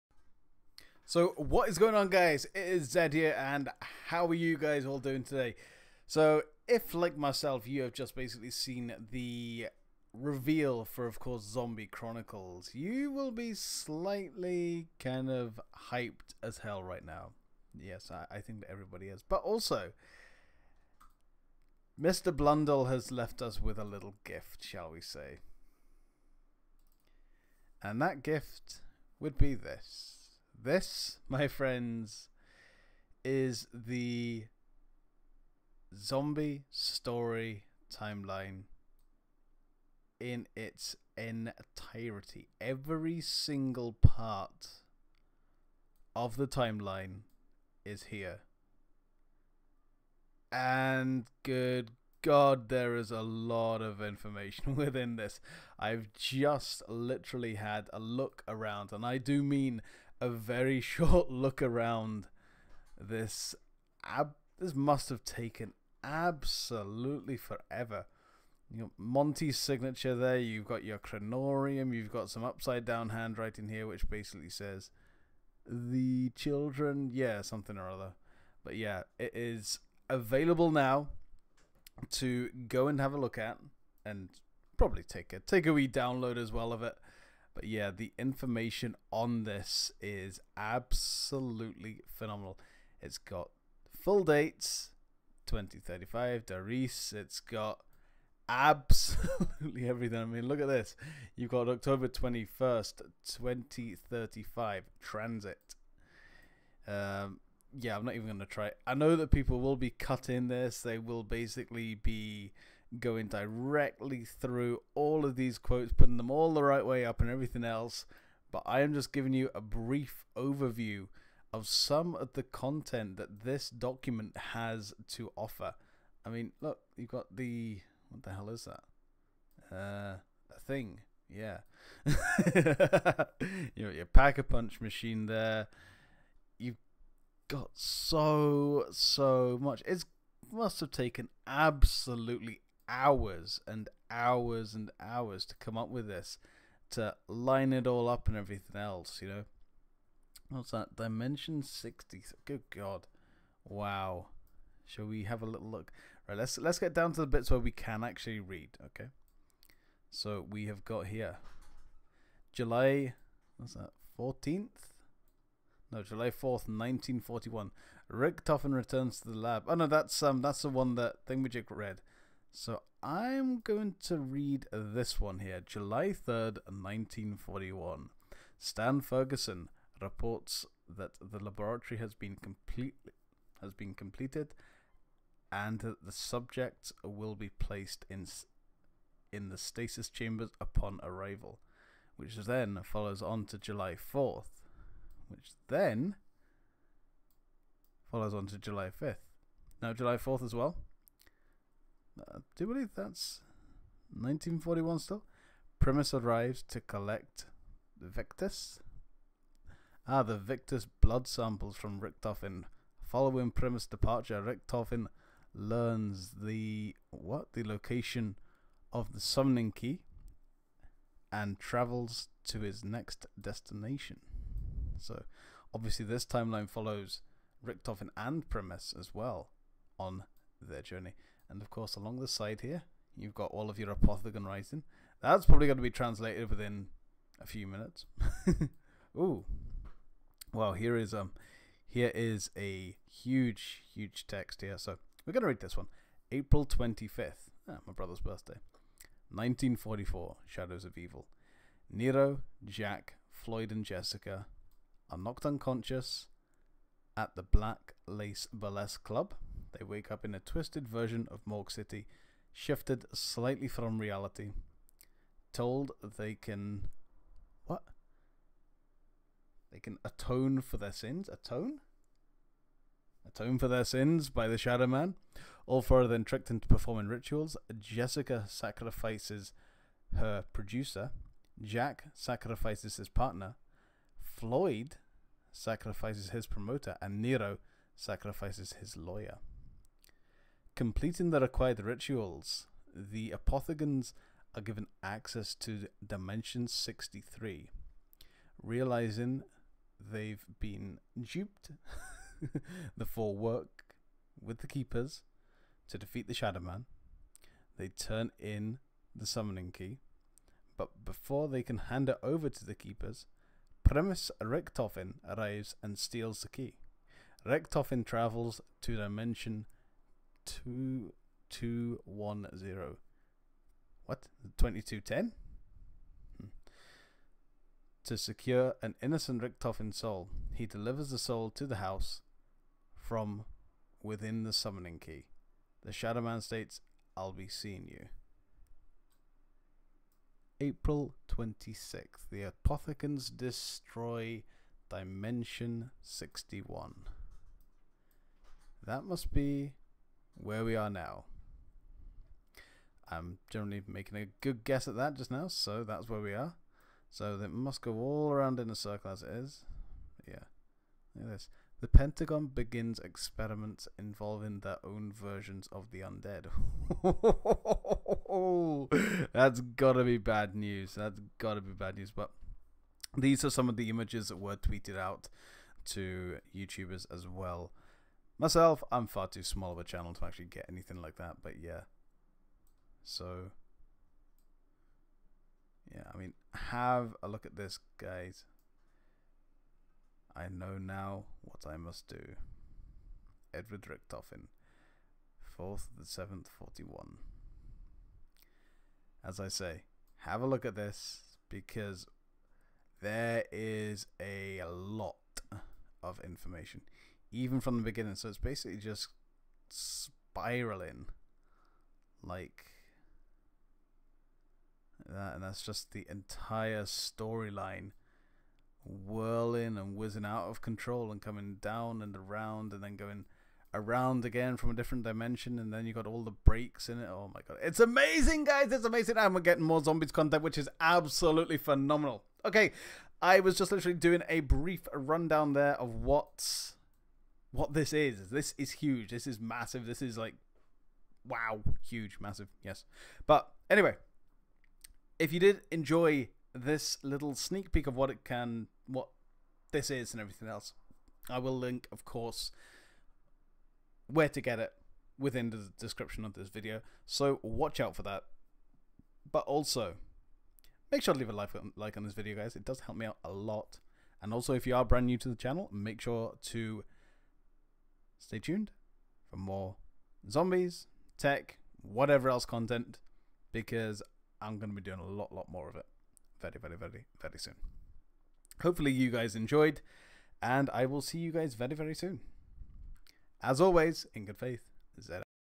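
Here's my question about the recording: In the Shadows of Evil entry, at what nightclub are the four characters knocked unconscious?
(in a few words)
Black Lace Burlesque Club.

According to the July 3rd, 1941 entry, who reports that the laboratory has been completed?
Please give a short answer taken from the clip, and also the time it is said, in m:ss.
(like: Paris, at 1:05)
Stan Ferguson, at 2:58.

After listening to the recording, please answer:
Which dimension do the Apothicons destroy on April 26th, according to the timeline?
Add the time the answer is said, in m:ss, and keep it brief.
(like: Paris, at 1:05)
Dimension 61, at 5:44.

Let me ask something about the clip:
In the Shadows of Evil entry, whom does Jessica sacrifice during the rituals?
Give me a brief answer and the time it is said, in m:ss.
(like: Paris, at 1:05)
her producer, at 4:40.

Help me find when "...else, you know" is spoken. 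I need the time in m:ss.
2:28.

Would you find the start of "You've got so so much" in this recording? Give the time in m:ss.
2:16.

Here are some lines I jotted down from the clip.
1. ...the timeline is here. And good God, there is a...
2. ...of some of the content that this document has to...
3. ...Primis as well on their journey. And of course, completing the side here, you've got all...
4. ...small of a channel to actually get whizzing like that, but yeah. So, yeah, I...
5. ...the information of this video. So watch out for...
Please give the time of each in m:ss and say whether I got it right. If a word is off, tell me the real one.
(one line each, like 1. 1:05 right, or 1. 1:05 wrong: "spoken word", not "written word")
1. 0:46 right
2. 2:01 right
3. 3:48 wrong: "along", not "completing"
4. 6:19 wrong: "anything", not "whizzing"
5. 7:35 wrong: "description", not "information".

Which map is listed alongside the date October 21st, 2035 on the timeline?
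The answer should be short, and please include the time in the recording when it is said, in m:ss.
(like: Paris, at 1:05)
TranZit, at 1:45.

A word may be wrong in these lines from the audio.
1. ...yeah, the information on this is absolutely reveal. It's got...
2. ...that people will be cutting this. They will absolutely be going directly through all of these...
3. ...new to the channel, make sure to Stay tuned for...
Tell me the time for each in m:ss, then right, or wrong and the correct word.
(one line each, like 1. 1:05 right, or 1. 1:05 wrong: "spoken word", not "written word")
1. 1:27 wrong: "phenomenal", not "reveal"
2. 1:49 wrong: "basically", not "absolutely"
3. 7:45 right.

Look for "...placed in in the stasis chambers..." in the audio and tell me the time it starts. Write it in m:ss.
3:07.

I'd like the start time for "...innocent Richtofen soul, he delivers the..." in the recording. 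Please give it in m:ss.
5:29.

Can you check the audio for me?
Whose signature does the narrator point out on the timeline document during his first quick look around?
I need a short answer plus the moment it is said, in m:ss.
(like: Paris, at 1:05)
Monty, at 1:08.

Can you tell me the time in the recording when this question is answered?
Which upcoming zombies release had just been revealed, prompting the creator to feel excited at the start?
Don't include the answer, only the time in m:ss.
0:11.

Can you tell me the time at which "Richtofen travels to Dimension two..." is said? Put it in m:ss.
5:17.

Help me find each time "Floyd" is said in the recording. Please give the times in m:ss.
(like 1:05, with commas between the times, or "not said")
4:13, 4:44.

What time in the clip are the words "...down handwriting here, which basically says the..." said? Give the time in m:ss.
1:12.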